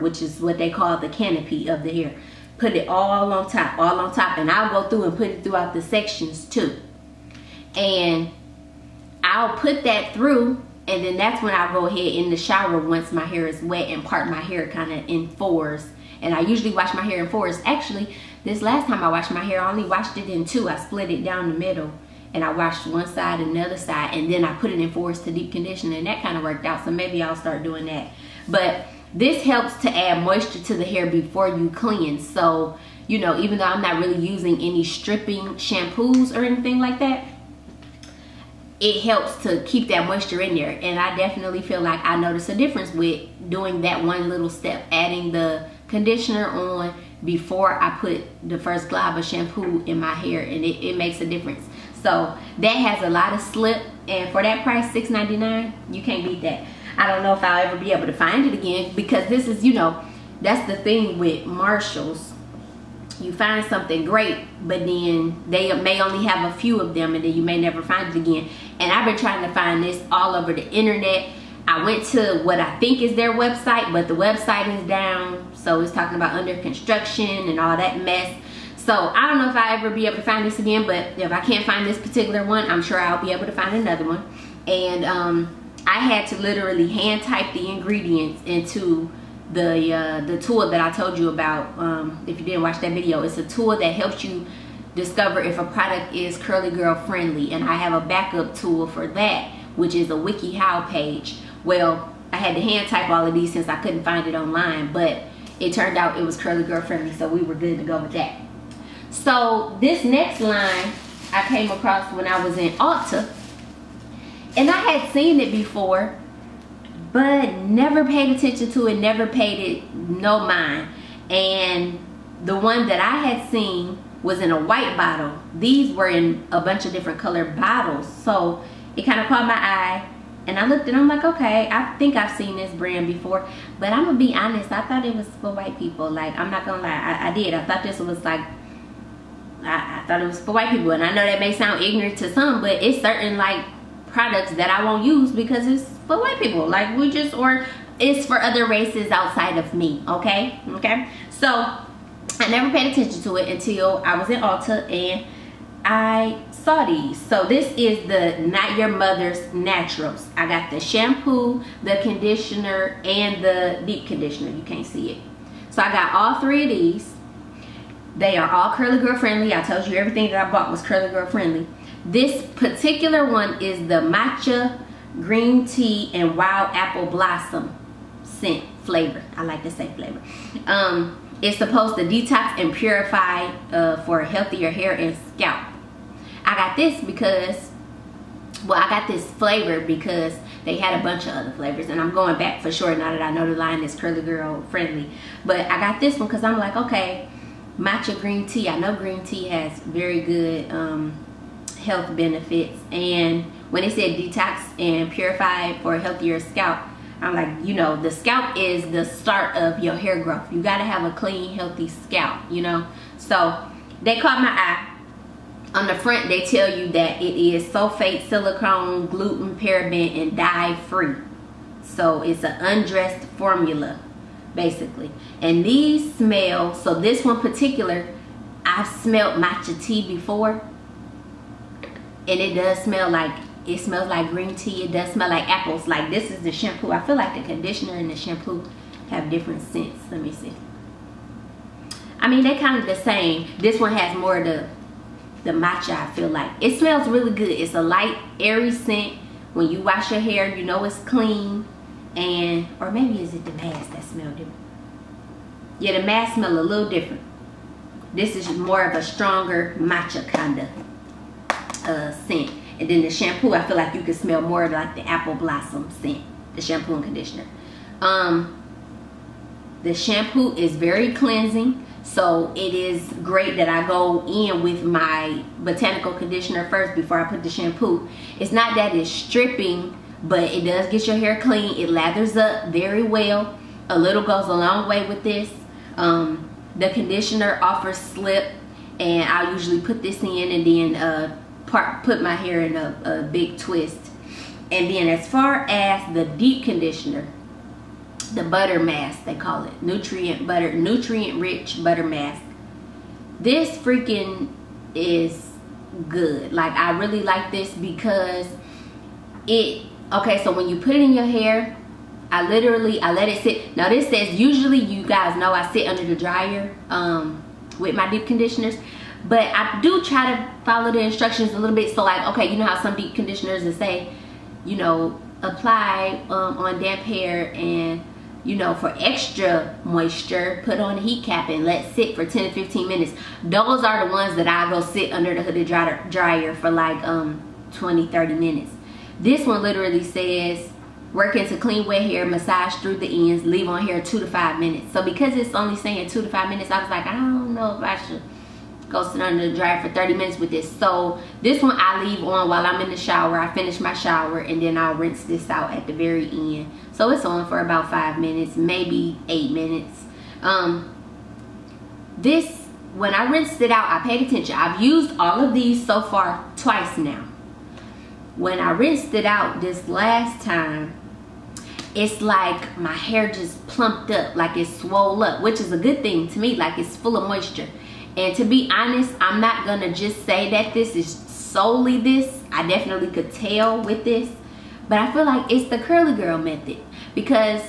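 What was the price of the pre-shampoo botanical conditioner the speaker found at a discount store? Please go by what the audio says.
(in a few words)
$6.99.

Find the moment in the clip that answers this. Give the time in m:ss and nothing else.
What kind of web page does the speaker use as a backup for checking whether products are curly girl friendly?
1:40.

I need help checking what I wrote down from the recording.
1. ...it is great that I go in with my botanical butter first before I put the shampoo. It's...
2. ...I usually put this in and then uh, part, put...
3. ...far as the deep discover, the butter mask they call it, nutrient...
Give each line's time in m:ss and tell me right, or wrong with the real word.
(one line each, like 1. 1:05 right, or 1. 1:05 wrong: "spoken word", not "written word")
1. 4:32 wrong: "conditioner", not "butter"
2. 4:49 right
3. 4:55 wrong: "conditioner", not "discover".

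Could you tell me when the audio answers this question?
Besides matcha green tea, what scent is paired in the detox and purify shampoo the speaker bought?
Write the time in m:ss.
2:56.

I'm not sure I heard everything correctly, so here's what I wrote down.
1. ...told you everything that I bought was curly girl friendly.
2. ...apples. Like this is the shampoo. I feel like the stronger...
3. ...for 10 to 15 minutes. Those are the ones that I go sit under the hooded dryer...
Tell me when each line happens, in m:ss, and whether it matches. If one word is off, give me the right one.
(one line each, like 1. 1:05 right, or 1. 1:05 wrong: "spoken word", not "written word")
1. 2:49 right
2. 3:55 wrong: "conditioner", not "stronger"
3. 5:32 right.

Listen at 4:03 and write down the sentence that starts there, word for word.
This one has more of the, the matcha, I feel like.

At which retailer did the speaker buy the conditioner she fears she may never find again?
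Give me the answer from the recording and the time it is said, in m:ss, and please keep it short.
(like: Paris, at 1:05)
Marshalls, at 1:01.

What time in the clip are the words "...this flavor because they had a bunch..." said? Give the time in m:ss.
3:09.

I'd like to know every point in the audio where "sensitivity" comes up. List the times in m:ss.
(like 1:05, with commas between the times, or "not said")
not said.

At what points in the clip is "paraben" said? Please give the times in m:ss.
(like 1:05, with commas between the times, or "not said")
3:39.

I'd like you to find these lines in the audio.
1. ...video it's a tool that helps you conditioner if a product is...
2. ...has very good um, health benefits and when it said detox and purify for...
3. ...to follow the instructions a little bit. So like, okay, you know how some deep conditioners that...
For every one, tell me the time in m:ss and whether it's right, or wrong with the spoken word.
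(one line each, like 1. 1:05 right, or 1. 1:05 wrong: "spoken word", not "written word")
1. 1:32 wrong: "discover", not "conditioner"
2. 3:19 right
3. 5:20 right.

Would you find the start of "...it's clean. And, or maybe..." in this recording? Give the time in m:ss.
4:10.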